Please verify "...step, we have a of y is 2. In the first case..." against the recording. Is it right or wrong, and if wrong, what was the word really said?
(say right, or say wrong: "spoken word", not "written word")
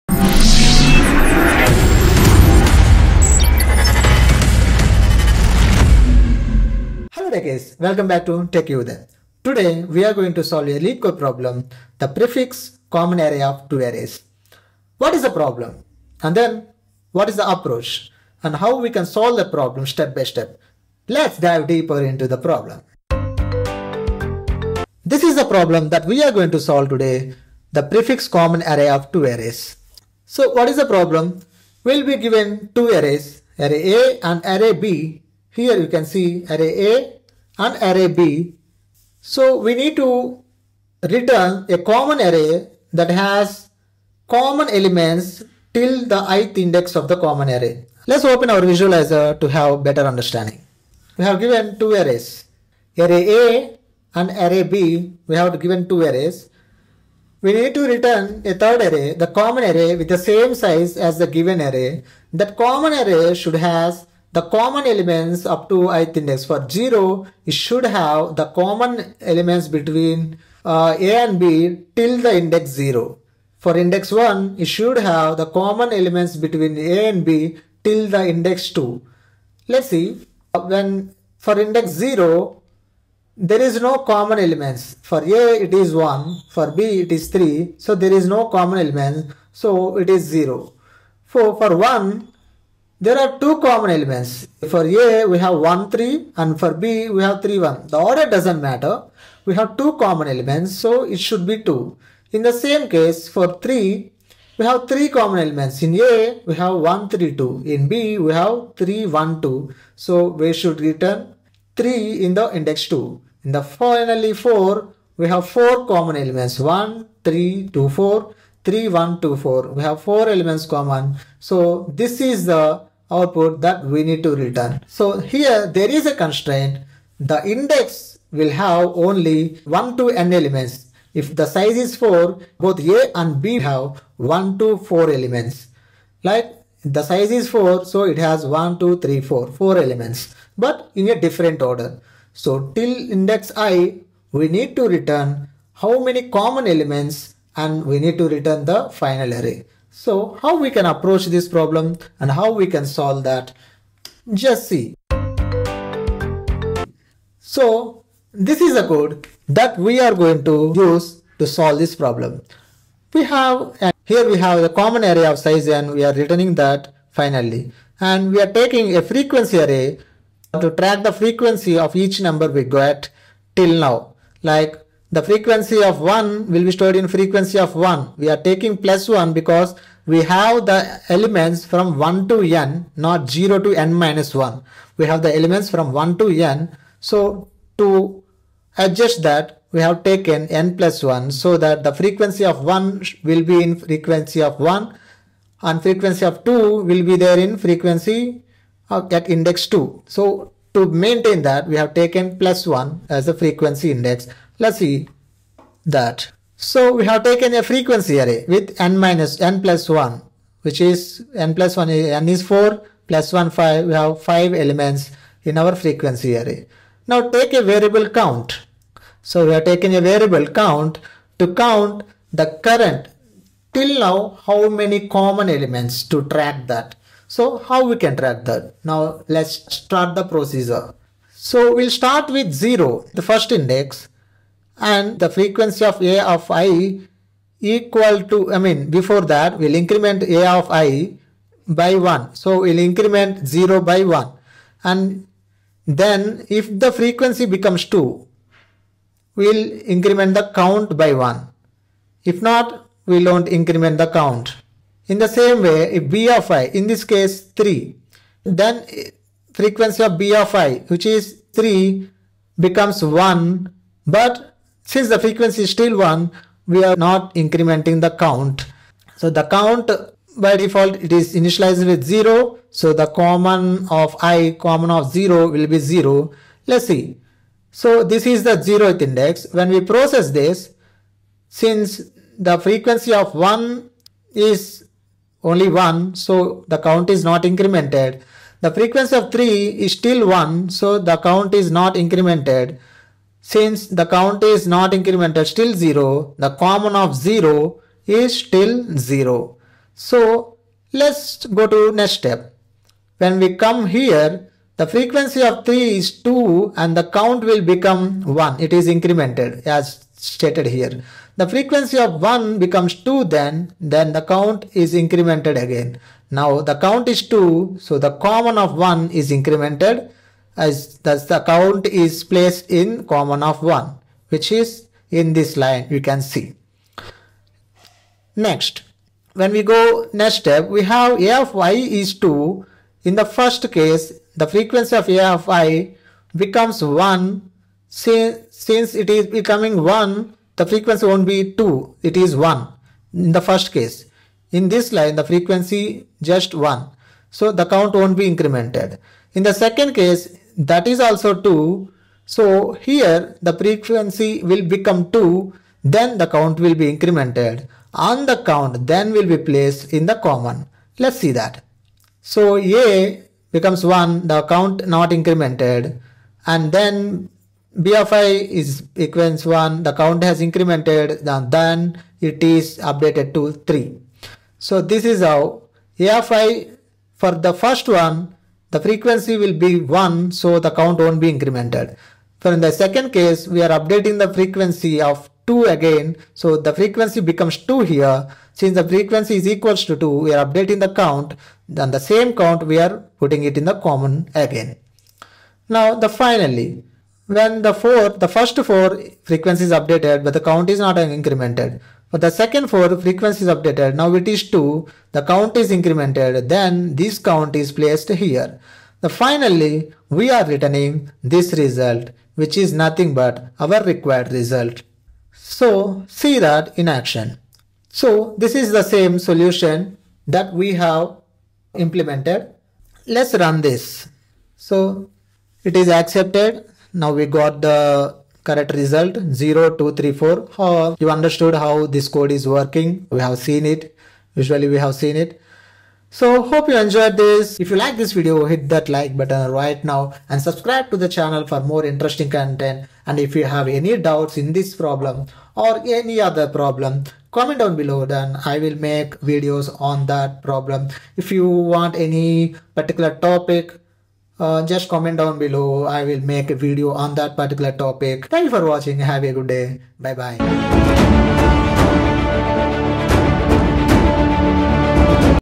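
right.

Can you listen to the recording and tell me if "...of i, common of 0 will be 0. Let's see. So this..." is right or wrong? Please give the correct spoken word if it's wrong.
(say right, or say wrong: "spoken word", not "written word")
right.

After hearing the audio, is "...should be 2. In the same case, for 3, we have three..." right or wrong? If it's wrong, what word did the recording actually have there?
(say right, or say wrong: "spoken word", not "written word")
right.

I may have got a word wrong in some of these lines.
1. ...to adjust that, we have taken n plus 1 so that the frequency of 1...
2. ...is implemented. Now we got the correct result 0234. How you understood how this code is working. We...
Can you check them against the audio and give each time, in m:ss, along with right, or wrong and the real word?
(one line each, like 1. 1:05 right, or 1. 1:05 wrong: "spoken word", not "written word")
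1. 3:07 right
2. 7:05 wrong: "accepted", not "implemented".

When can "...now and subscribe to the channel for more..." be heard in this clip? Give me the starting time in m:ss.
7:19.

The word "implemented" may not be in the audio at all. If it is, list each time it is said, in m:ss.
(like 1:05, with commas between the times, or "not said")
7:01.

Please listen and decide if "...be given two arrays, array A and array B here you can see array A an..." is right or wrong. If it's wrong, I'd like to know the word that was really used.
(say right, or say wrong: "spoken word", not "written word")
right.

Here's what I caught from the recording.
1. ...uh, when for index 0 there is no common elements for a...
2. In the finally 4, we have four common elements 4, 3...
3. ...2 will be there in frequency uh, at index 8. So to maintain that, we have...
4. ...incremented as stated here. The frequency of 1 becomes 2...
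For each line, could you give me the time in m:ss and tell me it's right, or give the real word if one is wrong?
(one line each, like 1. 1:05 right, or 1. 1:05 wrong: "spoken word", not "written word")
1. 1:20 right
2. 1:53 wrong: "1", not "4"
3. 3:16 wrong: "2", not "8"
4. 5:08 right.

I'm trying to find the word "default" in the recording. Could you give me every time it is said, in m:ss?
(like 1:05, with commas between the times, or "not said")
4:30.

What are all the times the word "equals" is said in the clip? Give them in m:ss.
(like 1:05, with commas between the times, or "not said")
3:57, 6:08, 6:29.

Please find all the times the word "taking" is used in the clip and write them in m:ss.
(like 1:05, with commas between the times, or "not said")
2:48, 2:58, 3:39.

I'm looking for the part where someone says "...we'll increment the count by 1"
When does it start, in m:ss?
4:09.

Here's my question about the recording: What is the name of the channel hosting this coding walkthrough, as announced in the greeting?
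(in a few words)
Techie Uday.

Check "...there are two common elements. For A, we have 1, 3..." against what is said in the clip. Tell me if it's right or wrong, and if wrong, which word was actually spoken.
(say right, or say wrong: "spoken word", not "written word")
right.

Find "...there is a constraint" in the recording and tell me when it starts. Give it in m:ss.
2:05.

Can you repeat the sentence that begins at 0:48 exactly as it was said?
Let's open our visualizer to have better understanding.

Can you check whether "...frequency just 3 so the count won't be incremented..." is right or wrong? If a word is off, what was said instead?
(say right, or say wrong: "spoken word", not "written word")
wrong: "1", not "3".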